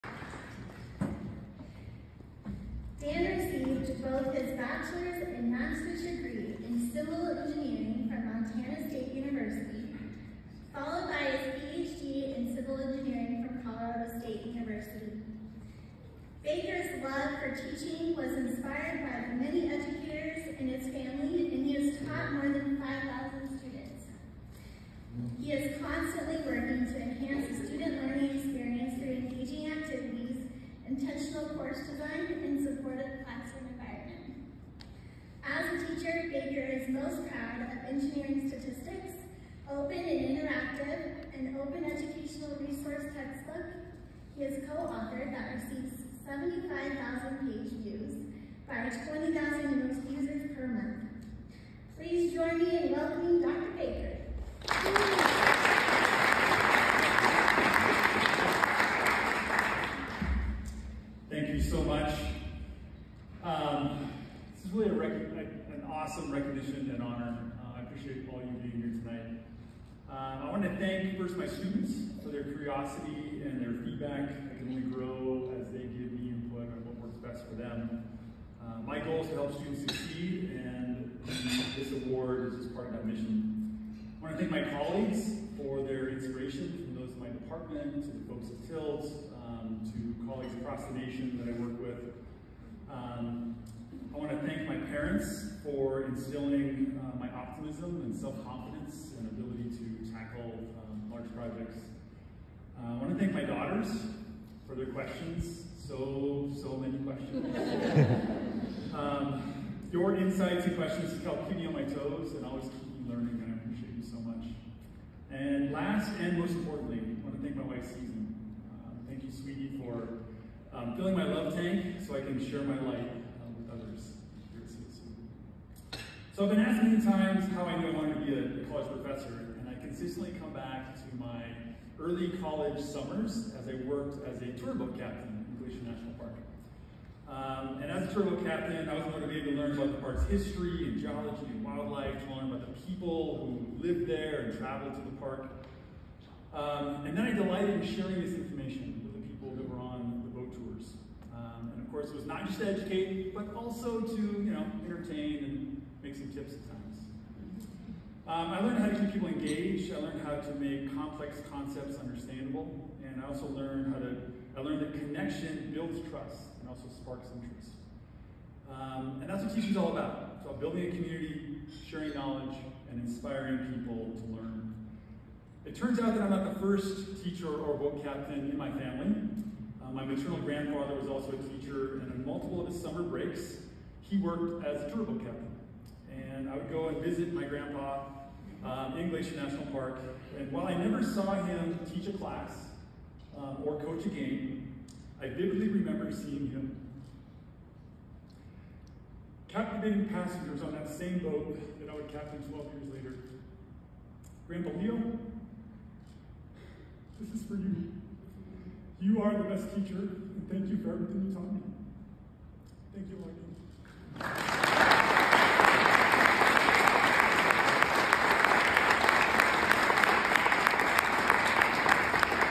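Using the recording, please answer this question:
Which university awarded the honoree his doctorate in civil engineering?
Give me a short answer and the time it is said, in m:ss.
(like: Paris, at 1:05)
Colorado State University, at 0:13.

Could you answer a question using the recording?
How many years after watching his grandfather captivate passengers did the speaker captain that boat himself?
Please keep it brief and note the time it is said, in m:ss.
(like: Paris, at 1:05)
12, at 3:22.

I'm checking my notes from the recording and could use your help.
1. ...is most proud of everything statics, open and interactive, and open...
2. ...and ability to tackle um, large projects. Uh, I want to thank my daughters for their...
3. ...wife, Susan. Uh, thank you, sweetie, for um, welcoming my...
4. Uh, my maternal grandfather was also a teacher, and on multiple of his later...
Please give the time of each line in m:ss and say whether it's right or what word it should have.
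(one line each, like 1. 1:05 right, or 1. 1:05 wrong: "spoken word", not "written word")
1. 0:36 wrong: "engineering", not "everything"
2. 1:39 right
3. 1:57 wrong: "filling", not "welcoming"
4. 2:59 wrong: "summer", not "later".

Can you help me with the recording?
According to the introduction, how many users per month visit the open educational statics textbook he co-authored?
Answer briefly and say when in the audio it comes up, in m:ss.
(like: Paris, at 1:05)
20,000, at 0:48.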